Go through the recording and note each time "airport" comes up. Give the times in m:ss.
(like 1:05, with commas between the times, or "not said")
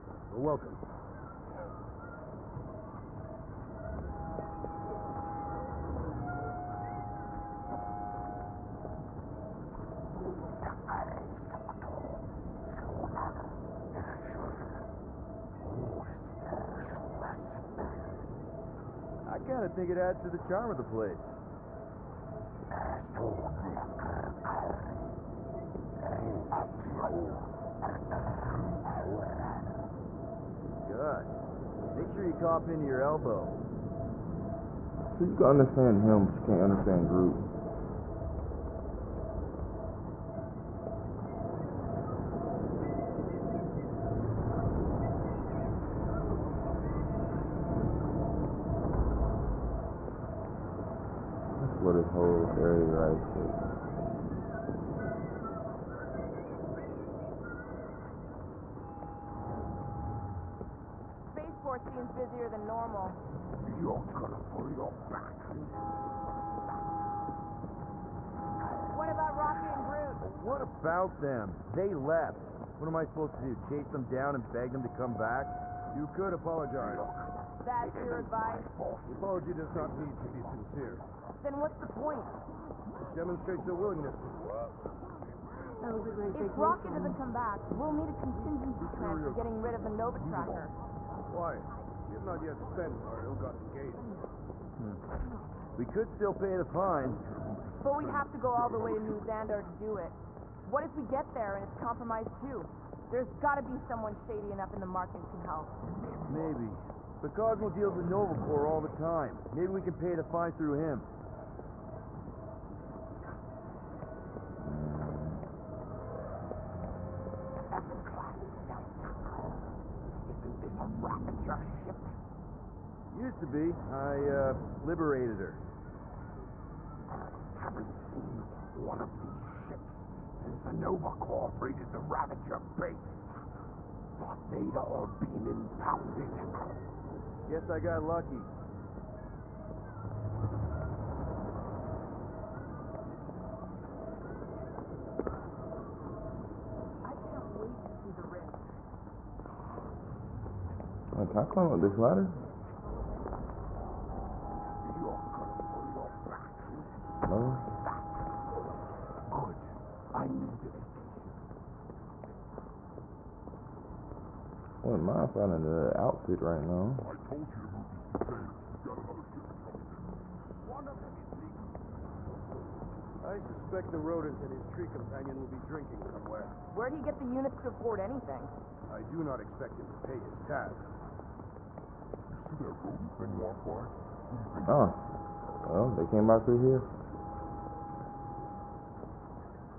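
1:01.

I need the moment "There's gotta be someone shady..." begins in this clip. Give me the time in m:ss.
1:43.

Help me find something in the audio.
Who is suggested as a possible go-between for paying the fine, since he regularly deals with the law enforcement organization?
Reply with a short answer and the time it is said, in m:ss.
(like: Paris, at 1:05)
Cosmo, at 1:47.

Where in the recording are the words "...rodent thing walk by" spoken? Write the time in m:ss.
3:02.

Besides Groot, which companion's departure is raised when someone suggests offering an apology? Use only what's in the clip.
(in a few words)
Rocky.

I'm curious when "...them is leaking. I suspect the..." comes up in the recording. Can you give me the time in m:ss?
2:50.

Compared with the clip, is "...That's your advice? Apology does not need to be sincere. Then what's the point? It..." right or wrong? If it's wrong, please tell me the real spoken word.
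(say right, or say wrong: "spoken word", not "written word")
right.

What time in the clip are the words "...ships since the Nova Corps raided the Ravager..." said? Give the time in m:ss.
2:09.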